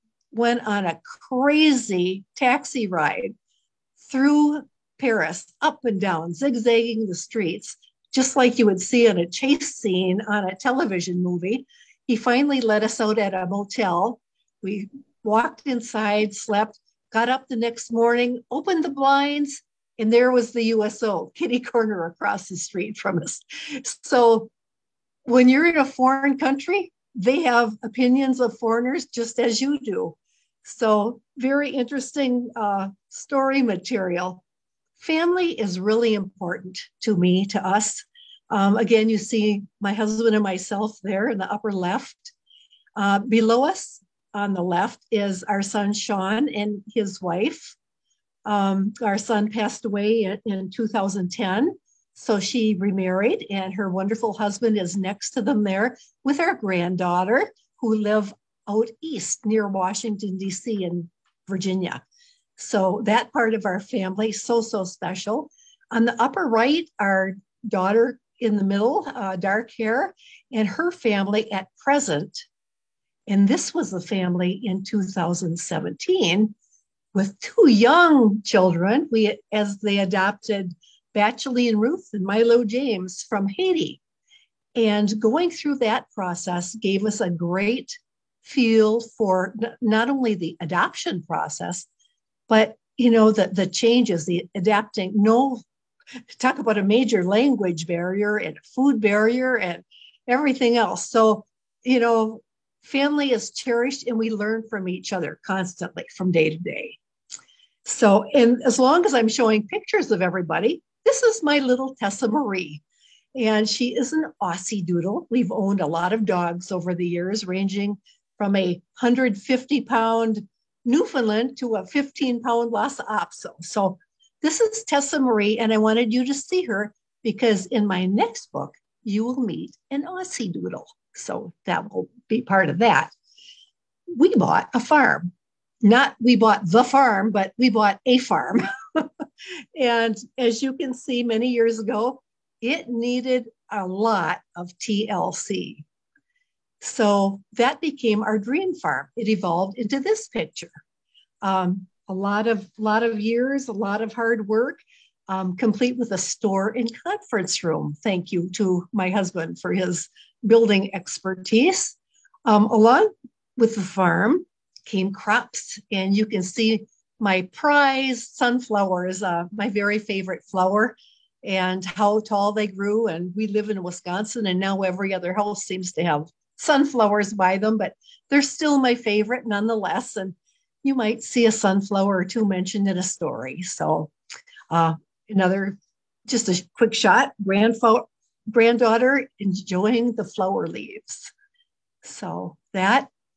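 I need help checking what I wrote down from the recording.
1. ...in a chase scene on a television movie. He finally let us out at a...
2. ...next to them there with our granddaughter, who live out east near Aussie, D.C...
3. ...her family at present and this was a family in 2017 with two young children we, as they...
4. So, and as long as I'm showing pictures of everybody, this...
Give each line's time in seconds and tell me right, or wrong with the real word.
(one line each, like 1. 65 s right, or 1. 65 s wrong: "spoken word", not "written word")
1. 9 s right
2. 54 s wrong: "Washington", not "Aussie"
3. 70 s right
4. 107 s right.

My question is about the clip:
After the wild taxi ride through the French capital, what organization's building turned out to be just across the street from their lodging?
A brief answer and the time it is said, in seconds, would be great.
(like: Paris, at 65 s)
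USO, at 20 s.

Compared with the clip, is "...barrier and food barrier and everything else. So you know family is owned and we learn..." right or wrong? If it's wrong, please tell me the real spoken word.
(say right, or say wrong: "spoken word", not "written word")
wrong: "cherished", not "owned".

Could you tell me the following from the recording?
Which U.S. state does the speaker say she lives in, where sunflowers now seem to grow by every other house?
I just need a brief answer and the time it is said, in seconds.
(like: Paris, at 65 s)
Wisconsin, at 173 s.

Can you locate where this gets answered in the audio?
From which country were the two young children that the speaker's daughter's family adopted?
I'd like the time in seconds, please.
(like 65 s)
83 s.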